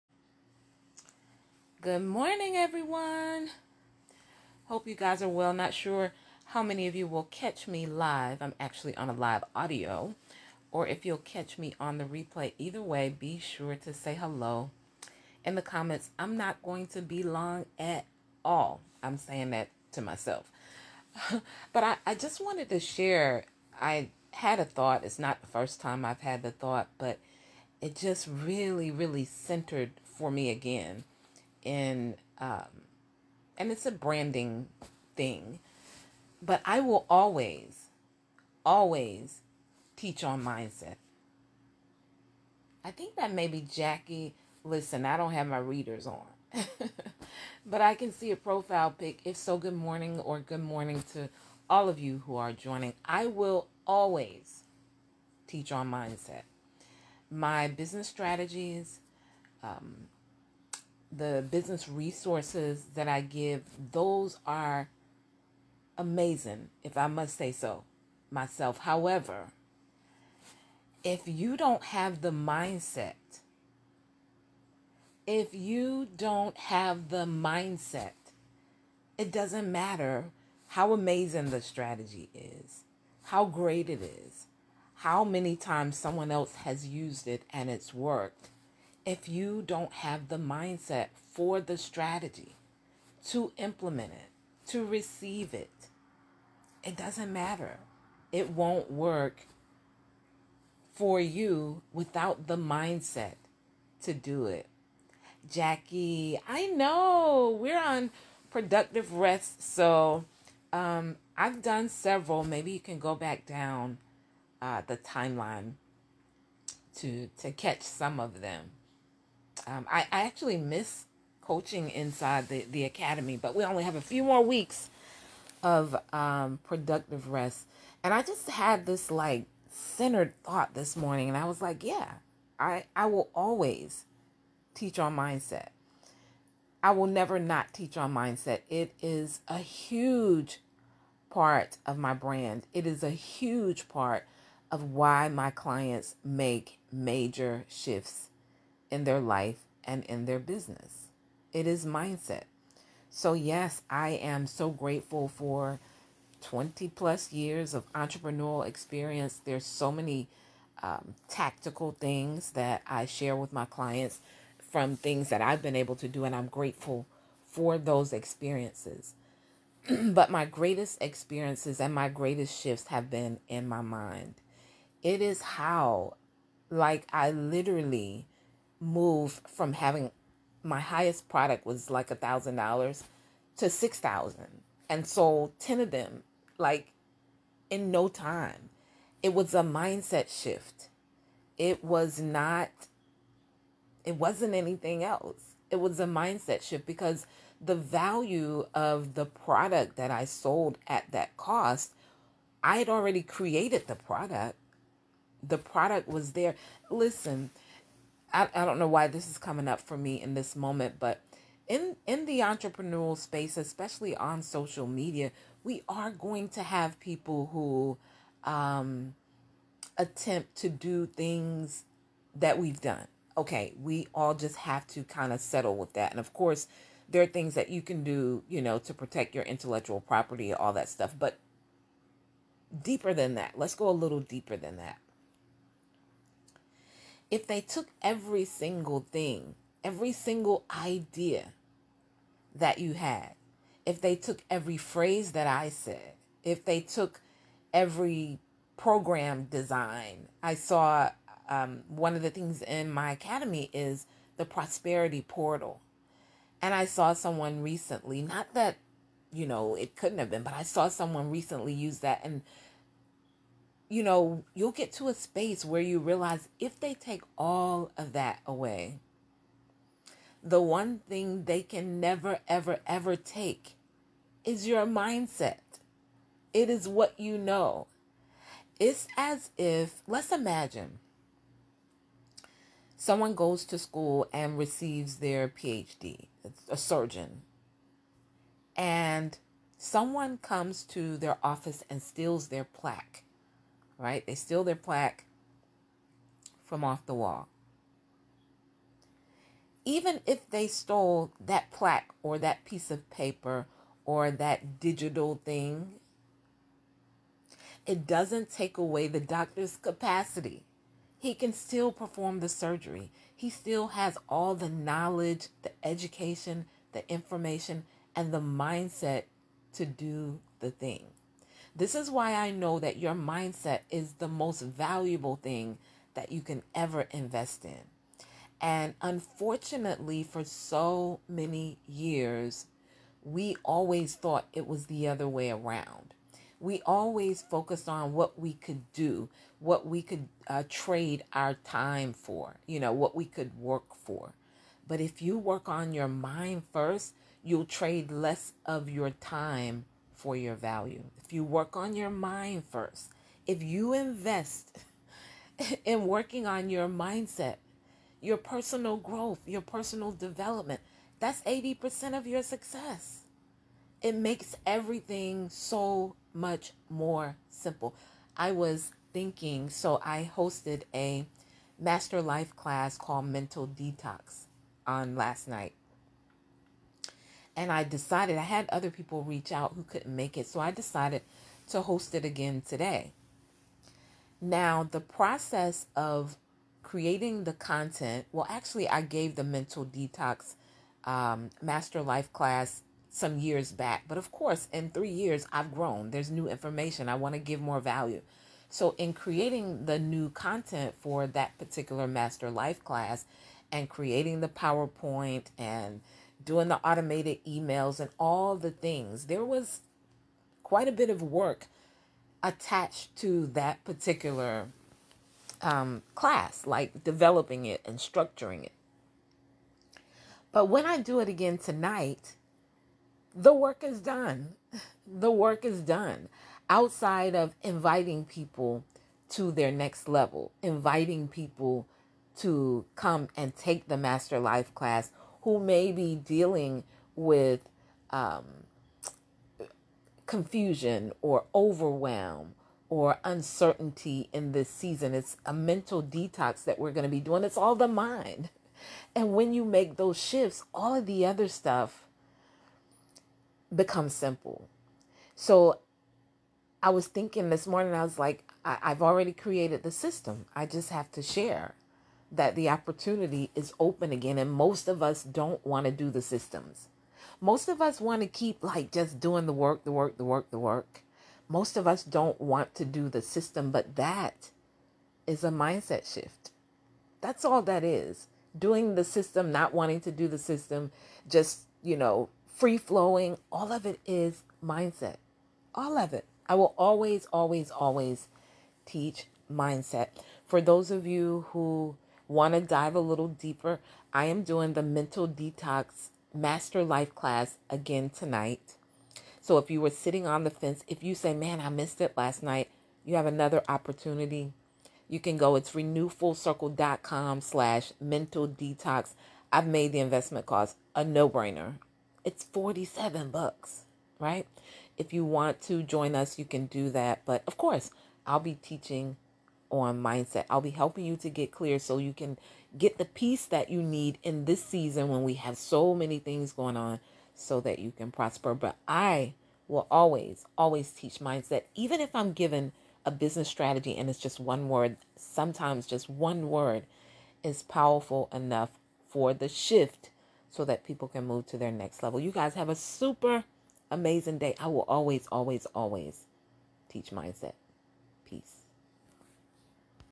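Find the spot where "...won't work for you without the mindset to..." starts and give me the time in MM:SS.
01:38.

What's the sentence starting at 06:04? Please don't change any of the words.
It makes everything so much more simple.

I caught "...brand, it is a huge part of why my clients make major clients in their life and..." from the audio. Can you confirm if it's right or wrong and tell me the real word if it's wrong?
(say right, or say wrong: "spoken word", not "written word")
wrong: "shifts", not "clients".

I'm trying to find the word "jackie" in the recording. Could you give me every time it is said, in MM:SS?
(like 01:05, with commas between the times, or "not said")
00:43, 01:45.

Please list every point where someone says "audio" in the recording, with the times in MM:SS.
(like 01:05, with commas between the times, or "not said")
00:09.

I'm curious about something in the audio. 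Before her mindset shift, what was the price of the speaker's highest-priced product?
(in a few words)
$1,000.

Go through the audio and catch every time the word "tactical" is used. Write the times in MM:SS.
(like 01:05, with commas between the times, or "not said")
02:41.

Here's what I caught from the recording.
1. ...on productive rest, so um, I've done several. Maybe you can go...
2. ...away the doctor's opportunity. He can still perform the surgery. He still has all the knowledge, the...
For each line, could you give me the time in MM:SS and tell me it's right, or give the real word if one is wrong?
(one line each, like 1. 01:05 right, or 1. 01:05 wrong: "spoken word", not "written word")
1. 01:47 right
2. 05:08 wrong: "capacity", not "opportunity".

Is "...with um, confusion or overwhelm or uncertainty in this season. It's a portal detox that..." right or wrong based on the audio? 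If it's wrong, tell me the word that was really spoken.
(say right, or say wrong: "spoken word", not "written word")
wrong: "mental", not "portal".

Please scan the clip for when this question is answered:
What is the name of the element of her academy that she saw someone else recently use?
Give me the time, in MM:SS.
04:14.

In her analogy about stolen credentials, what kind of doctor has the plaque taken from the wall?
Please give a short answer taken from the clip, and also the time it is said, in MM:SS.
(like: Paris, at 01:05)
A surgeon, at 04:46.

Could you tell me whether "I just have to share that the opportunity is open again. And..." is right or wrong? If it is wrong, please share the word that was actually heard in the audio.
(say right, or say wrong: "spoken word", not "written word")
right.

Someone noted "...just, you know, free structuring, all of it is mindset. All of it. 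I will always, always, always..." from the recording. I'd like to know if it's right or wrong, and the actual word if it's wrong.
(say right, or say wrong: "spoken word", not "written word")
wrong: "flowing", not "structuring".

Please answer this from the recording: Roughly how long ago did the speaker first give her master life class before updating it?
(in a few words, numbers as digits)
3 years.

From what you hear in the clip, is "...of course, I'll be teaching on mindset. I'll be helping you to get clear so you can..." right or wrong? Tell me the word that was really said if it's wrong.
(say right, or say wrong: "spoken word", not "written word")
right.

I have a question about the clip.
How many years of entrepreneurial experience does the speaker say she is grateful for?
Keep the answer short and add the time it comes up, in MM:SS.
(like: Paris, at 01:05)
20 plus, at 02:36.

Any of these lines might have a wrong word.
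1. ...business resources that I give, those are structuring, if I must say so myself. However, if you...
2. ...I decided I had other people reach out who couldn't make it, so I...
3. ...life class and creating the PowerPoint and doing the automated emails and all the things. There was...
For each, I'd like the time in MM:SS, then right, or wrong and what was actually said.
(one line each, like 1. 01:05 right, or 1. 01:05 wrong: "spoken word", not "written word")
1. 01:01 wrong: "amazing", not "structuring"
2. 06:17 right
3. 06:42 right.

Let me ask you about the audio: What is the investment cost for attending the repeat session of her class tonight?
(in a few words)
$47.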